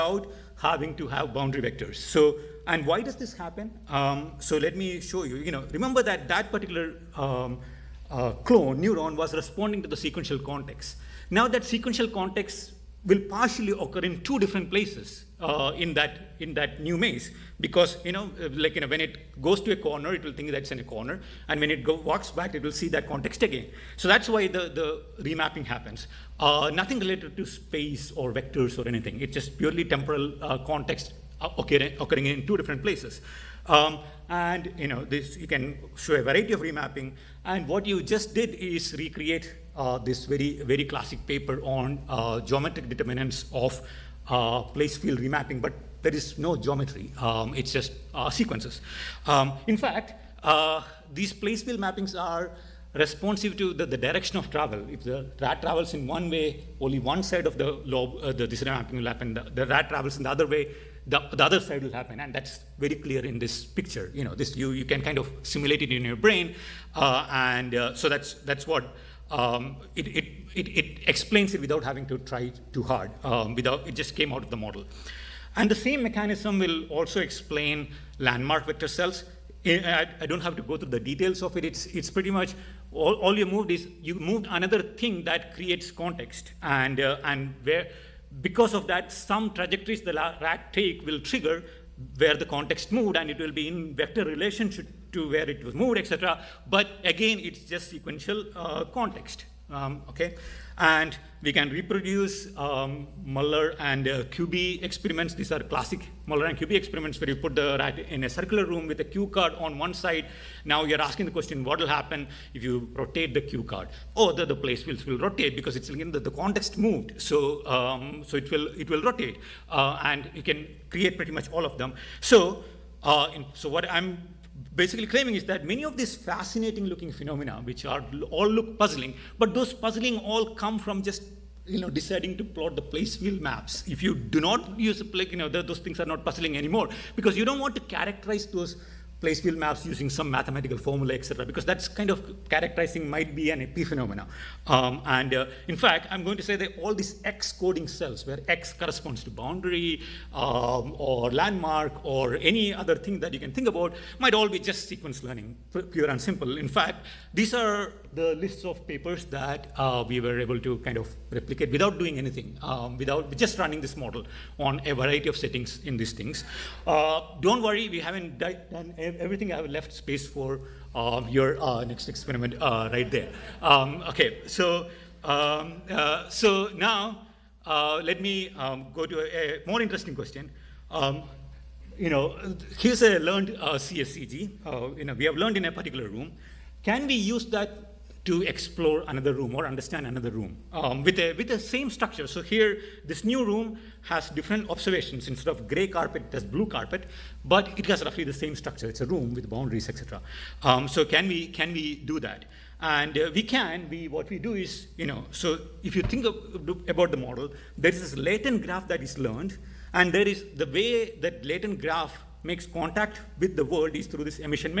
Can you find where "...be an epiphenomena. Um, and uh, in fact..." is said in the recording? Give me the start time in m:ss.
2:23.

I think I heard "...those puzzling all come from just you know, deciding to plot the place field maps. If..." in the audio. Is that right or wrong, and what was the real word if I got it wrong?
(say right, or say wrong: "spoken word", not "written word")
right.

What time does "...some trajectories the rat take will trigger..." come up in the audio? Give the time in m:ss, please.
1:29.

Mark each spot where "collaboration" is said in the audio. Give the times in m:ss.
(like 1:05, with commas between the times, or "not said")
not said.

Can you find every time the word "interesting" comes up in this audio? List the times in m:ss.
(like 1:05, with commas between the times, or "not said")
2:59.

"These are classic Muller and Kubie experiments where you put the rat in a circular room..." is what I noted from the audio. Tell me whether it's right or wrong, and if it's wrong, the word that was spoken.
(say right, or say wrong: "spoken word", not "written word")
right.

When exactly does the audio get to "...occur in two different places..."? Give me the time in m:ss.
0:13.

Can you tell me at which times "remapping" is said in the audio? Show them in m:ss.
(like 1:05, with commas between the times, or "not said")
0:25, 0:36, 0:45.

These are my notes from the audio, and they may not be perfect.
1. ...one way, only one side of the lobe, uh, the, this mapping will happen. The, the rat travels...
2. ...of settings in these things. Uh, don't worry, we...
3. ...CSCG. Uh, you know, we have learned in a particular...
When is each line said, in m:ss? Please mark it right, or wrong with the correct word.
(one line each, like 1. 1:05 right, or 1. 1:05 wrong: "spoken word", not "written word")
1. 0:56 right
2. 2:45 right
3. 3:03 right.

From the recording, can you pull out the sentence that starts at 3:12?
So here, this new room has different observations.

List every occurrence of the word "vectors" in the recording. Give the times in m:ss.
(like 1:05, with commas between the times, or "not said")
0:01, 0:28, 1:18, 1:33.